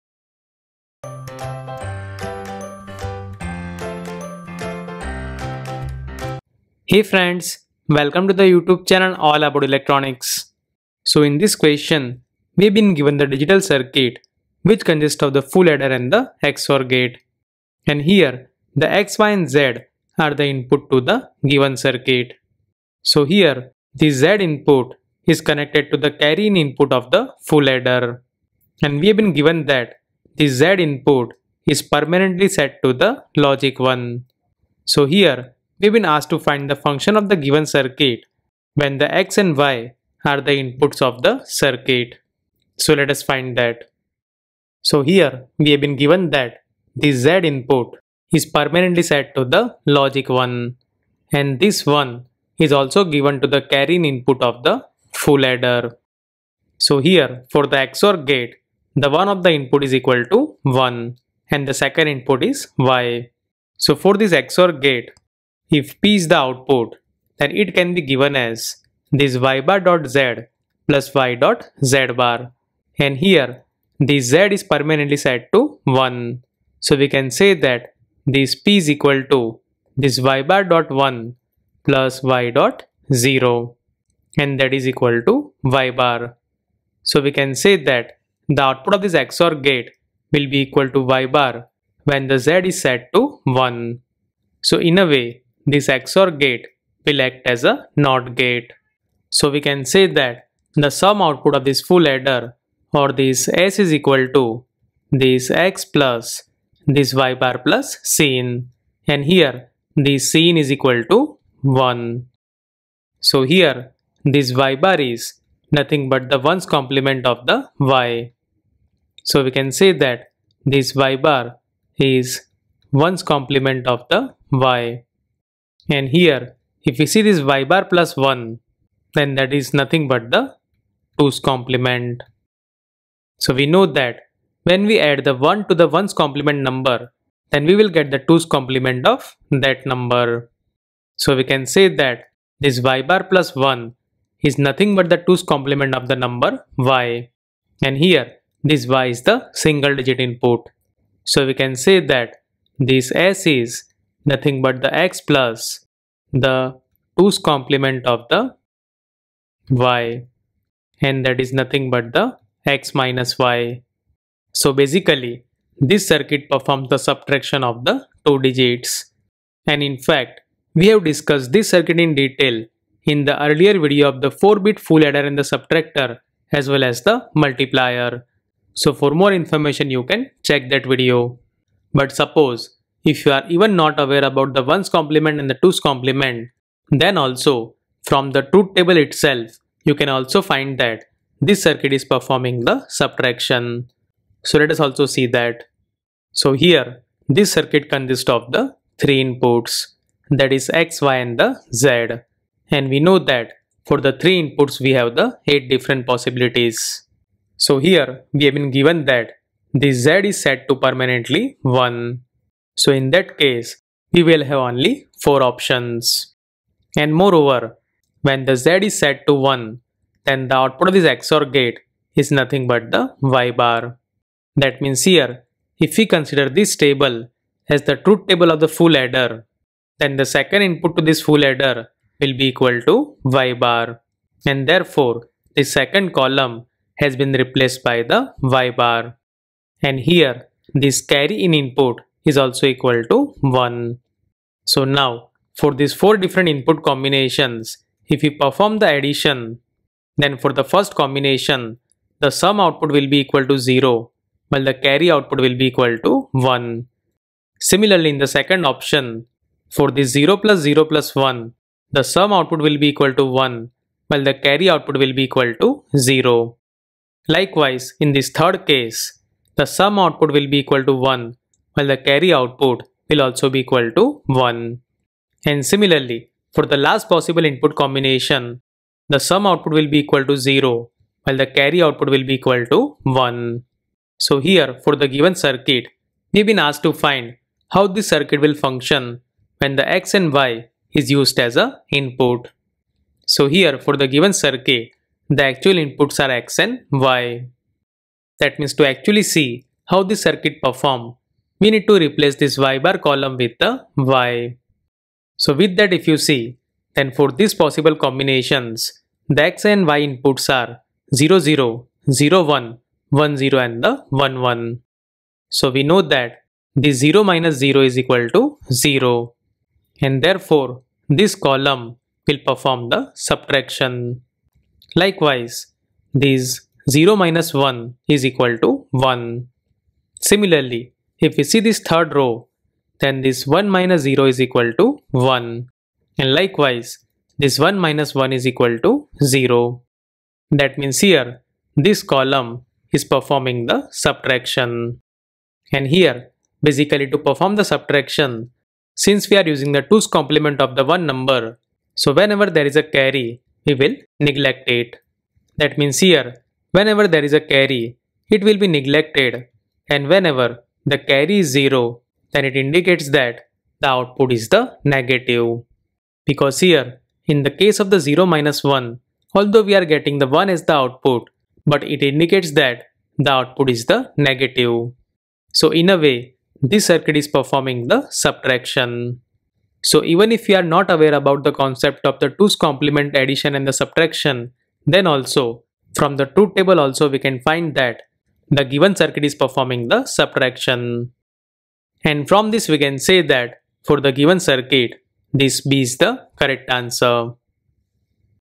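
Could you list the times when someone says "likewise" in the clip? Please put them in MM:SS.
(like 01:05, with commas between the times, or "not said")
04:27, 05:24, 05:36.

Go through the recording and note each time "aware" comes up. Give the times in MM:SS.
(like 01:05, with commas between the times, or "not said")
03:03, 06:20.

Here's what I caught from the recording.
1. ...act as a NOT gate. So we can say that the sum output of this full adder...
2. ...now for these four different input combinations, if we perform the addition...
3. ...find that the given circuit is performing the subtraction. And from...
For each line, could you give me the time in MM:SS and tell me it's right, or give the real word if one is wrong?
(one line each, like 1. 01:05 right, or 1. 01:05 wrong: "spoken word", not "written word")
1. 01:37 right
2. 04:04 right
3. 06:27 right.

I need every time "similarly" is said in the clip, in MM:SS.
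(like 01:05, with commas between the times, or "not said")
04:17, 04:35, 05:30.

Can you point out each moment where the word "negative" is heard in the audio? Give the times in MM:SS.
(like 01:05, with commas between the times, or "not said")
06:04, 06:14.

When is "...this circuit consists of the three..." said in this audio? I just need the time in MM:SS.
03:17.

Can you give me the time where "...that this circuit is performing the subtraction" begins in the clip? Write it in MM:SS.
03:10.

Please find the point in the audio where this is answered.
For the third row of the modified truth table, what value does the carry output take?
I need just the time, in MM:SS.
04:33.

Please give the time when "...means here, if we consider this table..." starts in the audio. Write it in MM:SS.
03:44.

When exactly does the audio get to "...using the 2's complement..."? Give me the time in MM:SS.
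05:49.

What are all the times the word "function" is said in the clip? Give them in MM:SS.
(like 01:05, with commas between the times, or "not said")
00:36, 04:48.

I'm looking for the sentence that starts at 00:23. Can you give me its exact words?
So here, the Z input is connected to the carry in input of the full adder.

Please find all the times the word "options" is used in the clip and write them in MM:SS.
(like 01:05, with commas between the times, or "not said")
03:35, 04:18.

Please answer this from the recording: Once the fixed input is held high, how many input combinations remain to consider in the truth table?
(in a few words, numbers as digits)
4.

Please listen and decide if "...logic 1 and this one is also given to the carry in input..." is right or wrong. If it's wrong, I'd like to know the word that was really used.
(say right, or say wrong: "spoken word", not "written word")
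right.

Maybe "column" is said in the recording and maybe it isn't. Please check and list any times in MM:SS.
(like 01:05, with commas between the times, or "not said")
03:56, 05:03, 05:21, 05:42.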